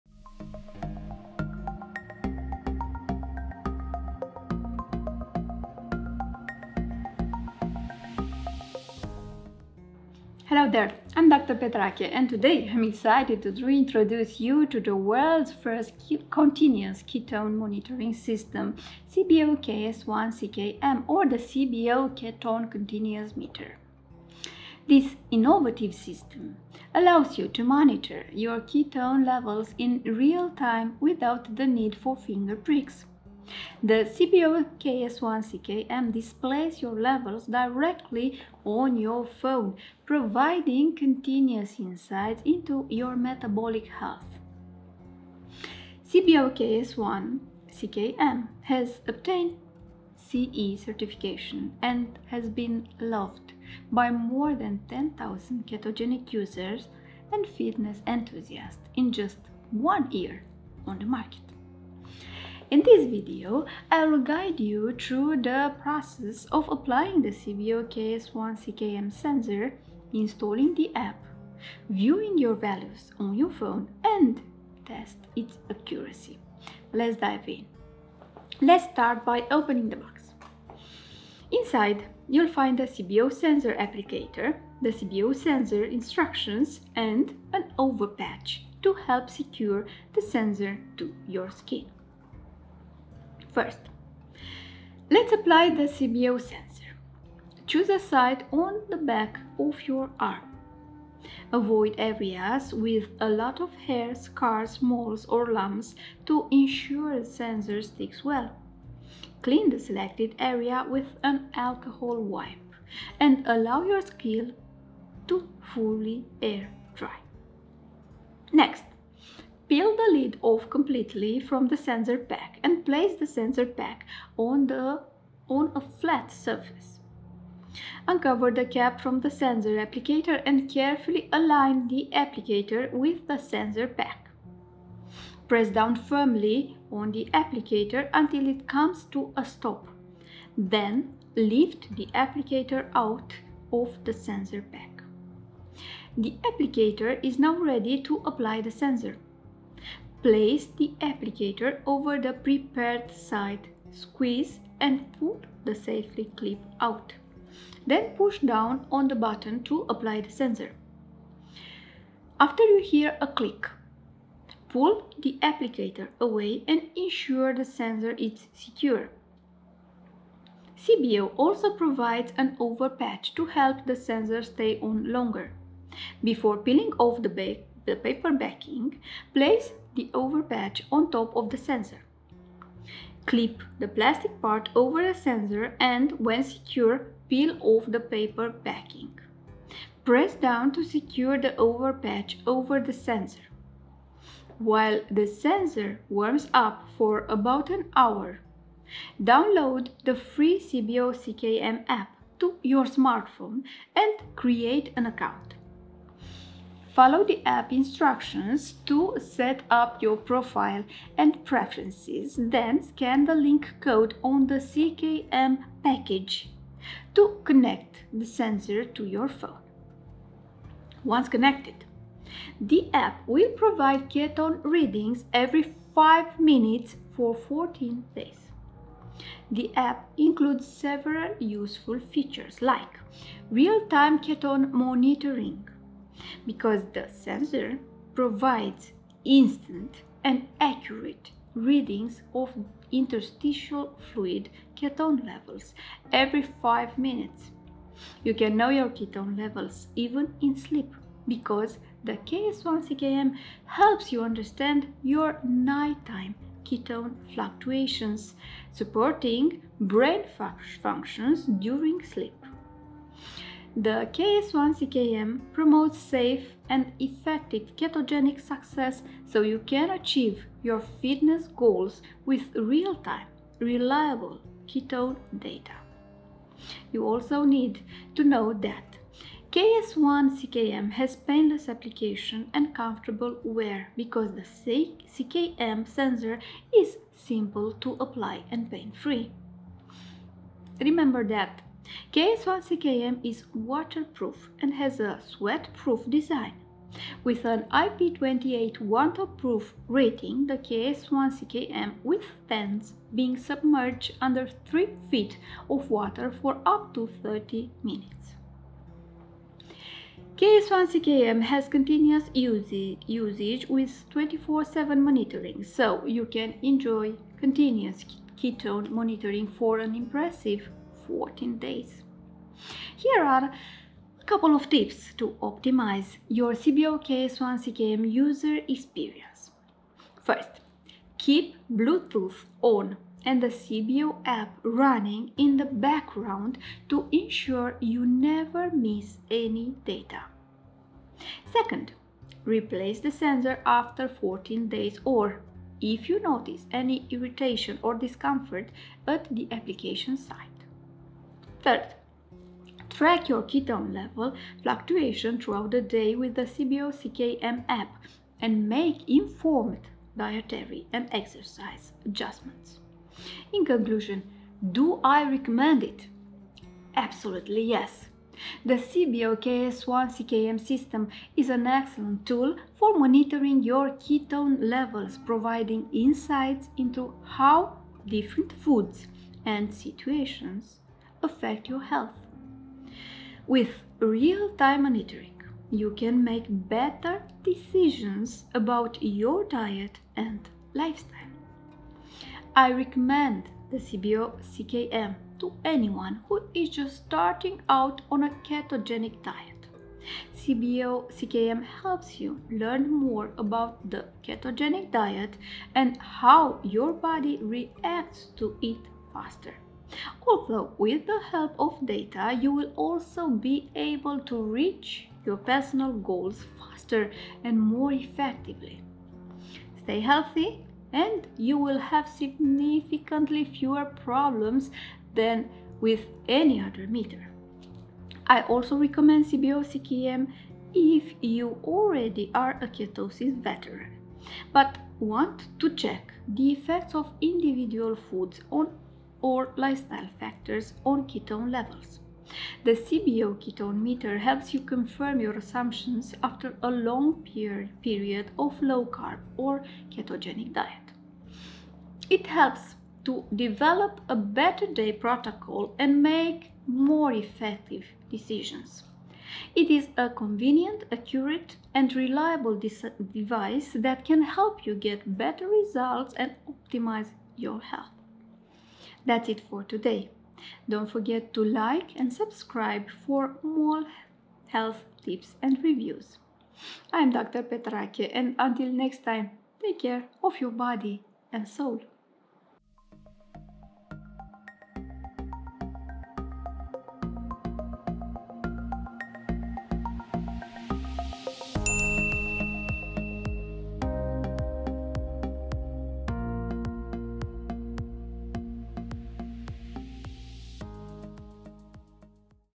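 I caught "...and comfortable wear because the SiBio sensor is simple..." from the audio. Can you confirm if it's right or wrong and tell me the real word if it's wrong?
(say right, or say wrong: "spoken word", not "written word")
wrong: "CKM", not "SiBio".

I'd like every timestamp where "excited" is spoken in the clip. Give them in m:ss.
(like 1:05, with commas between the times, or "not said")
0:12.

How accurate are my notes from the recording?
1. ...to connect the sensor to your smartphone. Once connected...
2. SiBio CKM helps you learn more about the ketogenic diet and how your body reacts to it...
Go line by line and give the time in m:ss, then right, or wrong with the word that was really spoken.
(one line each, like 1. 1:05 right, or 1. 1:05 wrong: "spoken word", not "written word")
1. 3:37 wrong: "phone", not "smartphone"
2. 6:40 right.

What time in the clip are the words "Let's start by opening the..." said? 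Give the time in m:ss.
1:18.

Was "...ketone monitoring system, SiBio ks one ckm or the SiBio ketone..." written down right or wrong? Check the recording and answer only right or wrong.
right.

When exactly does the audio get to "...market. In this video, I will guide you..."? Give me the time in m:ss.
1:01.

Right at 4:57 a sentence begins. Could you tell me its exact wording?
With an IP28 waterproof rating, the KS1CKM withstands being submerged under 3 feet of water for up to 30 minutes.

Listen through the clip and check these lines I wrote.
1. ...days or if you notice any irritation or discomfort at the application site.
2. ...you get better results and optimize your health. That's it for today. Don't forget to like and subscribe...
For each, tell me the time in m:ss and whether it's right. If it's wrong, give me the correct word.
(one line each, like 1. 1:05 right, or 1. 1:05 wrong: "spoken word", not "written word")
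1. 5:44 right
2. 7:44 right.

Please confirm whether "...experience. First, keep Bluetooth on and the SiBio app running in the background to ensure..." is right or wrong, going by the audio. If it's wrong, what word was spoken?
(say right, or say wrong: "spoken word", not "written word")
right.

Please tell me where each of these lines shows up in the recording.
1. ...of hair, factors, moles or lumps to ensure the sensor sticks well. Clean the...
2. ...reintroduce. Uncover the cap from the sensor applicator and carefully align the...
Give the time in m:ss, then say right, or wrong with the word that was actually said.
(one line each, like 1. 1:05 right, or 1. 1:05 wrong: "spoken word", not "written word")
1. 1:43 wrong: "scars", not "factors"
2. 2:06 wrong: "surface", not "reintroduce".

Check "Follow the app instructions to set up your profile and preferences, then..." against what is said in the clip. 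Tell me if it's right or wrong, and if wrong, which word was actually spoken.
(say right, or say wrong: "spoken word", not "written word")
right.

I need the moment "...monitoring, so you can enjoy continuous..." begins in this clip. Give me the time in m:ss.
5:14.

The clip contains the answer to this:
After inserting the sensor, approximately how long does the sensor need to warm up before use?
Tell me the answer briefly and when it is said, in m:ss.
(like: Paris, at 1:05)
About an hour, at 3:17.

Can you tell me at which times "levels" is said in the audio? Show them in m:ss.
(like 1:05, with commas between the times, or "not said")
0:29, 0:36, 4:05, 4:09, 5:53, 6:14, 7:21.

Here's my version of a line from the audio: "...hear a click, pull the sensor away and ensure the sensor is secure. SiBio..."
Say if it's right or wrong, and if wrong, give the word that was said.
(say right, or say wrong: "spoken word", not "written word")
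wrong: "applicator", not "sensor".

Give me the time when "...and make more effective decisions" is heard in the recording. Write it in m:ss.
7:35.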